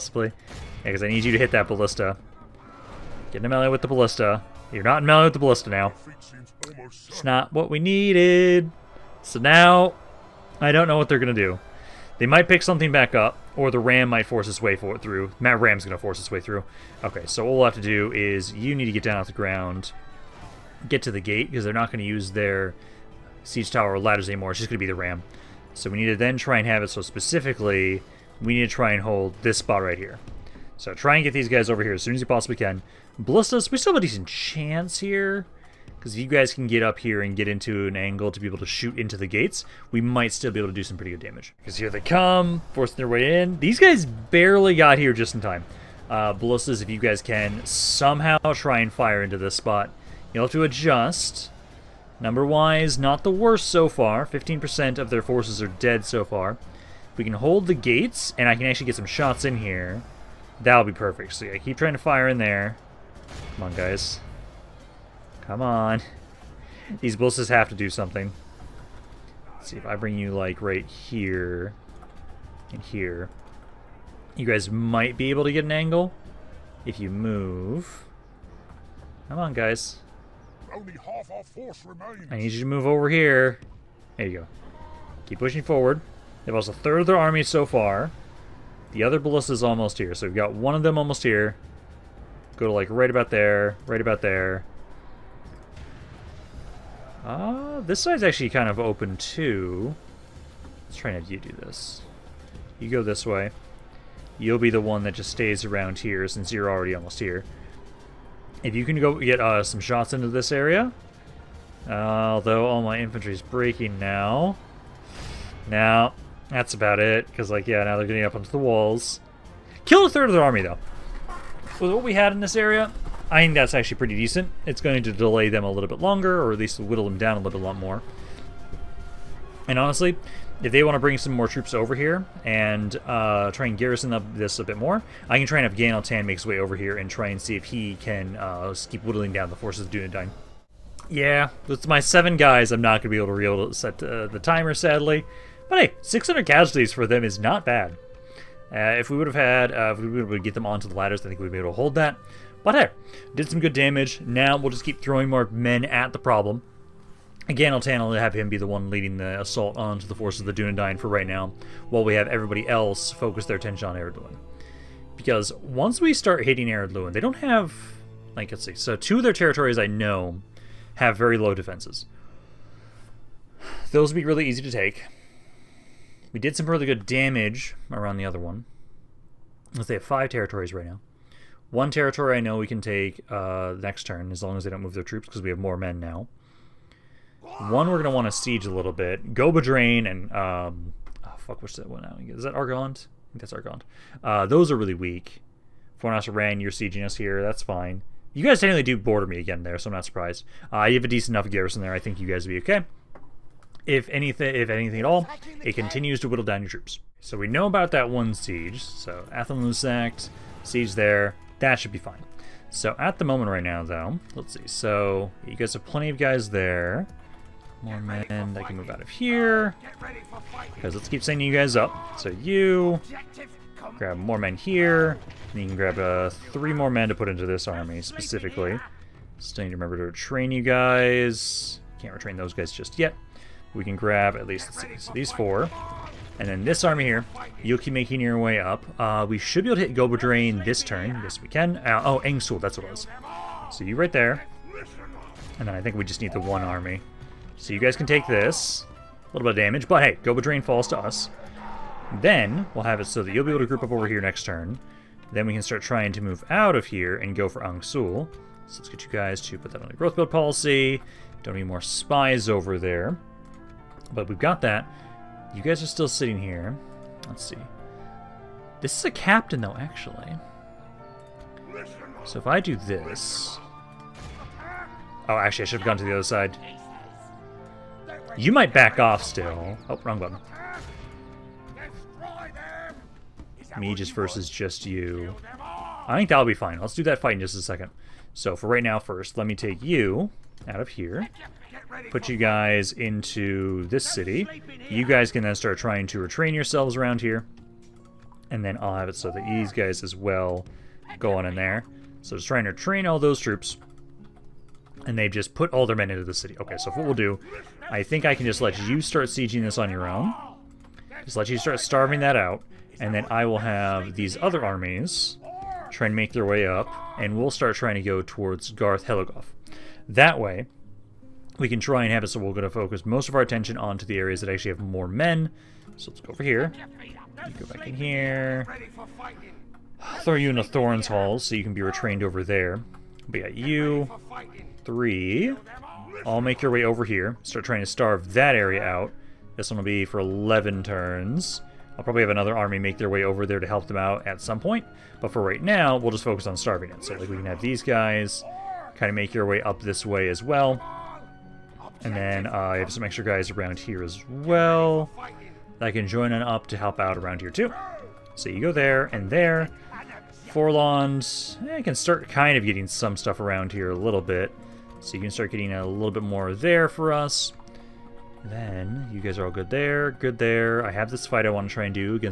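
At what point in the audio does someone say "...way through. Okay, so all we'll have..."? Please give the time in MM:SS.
00:16.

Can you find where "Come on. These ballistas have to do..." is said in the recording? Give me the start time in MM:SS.
01:05.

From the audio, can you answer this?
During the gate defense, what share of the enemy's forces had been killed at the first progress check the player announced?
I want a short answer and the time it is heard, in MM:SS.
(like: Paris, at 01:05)
15%, at 00:54.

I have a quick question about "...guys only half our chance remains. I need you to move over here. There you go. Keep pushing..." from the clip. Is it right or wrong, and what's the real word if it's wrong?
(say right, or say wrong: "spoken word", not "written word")
wrong: "force", not "chance".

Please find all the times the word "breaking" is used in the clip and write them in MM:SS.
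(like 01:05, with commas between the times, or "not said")
01:53.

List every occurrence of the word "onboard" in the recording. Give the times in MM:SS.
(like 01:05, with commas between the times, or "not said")
not said.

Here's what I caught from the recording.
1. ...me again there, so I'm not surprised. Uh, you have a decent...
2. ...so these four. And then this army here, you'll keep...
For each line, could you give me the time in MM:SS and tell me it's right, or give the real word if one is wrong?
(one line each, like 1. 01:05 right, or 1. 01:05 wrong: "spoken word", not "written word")
1. 03:19 right
2. 03:54 right.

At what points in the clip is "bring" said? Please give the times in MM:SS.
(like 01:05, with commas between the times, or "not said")
01:09, 02:10.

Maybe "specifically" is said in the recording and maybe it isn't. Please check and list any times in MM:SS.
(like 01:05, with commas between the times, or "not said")
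00:27, 03:48.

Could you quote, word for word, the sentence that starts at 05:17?
And we'll start trying to go towards Garth Heligoth.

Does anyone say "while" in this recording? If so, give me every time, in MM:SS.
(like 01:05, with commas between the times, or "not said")
02:41.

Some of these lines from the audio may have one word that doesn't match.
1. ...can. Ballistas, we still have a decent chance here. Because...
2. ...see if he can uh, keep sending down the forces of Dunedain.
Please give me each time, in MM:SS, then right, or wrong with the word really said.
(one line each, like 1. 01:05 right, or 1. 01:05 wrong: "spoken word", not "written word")
1. 00:32 right
2. 02:17 wrong: "whittling", not "sending".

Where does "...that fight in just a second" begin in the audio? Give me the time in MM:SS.
04:47.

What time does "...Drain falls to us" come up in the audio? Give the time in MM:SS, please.
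04:10.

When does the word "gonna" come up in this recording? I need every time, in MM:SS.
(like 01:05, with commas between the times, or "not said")
03:07.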